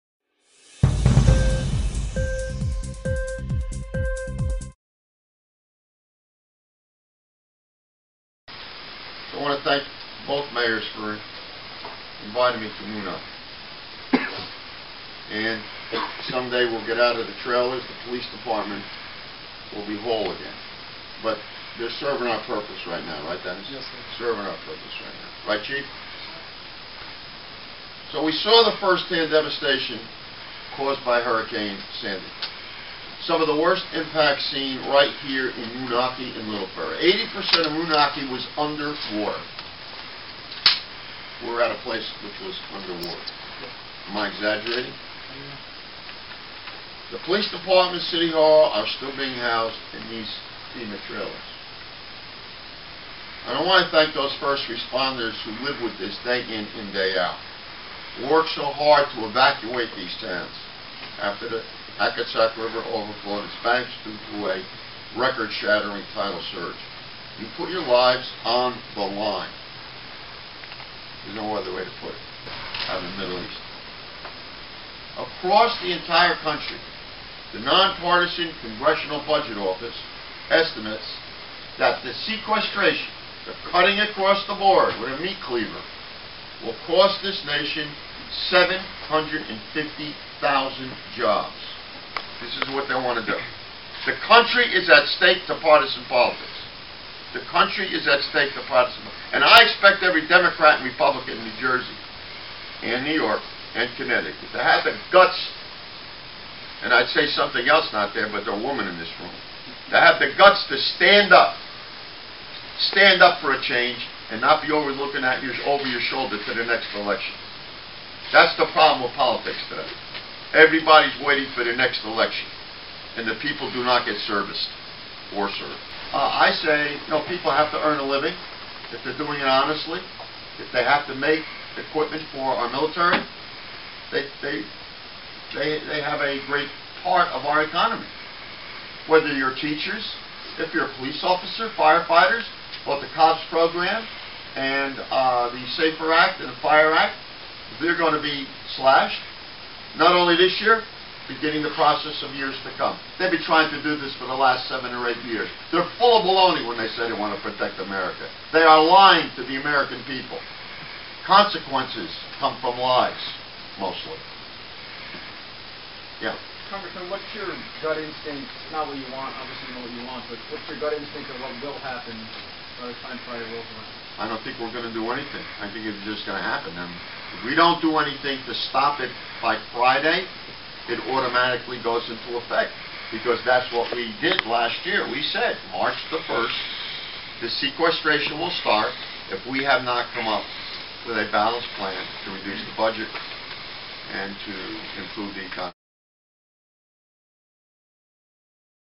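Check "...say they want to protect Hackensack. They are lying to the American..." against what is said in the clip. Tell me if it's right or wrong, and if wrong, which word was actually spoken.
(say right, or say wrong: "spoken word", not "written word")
wrong: "America", not "Hackensack".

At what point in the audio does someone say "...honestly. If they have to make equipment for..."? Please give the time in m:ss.
2:09.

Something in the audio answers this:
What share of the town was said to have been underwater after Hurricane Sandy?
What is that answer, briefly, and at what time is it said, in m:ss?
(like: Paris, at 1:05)
80%, at 0:37.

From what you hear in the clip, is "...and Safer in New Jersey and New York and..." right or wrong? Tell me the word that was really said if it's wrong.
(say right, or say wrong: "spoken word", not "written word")
wrong: "Republican", not "Safer".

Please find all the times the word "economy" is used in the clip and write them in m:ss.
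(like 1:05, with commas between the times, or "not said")
2:17, 3:15.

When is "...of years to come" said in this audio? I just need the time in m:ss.
2:32.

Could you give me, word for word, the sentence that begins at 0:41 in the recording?
We are at a place which was underwater.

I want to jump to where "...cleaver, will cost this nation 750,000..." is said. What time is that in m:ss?
1:25.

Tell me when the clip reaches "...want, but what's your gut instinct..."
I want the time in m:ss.
2:50.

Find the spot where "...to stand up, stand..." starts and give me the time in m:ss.
1:50.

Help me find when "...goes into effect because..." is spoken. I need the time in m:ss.
3:01.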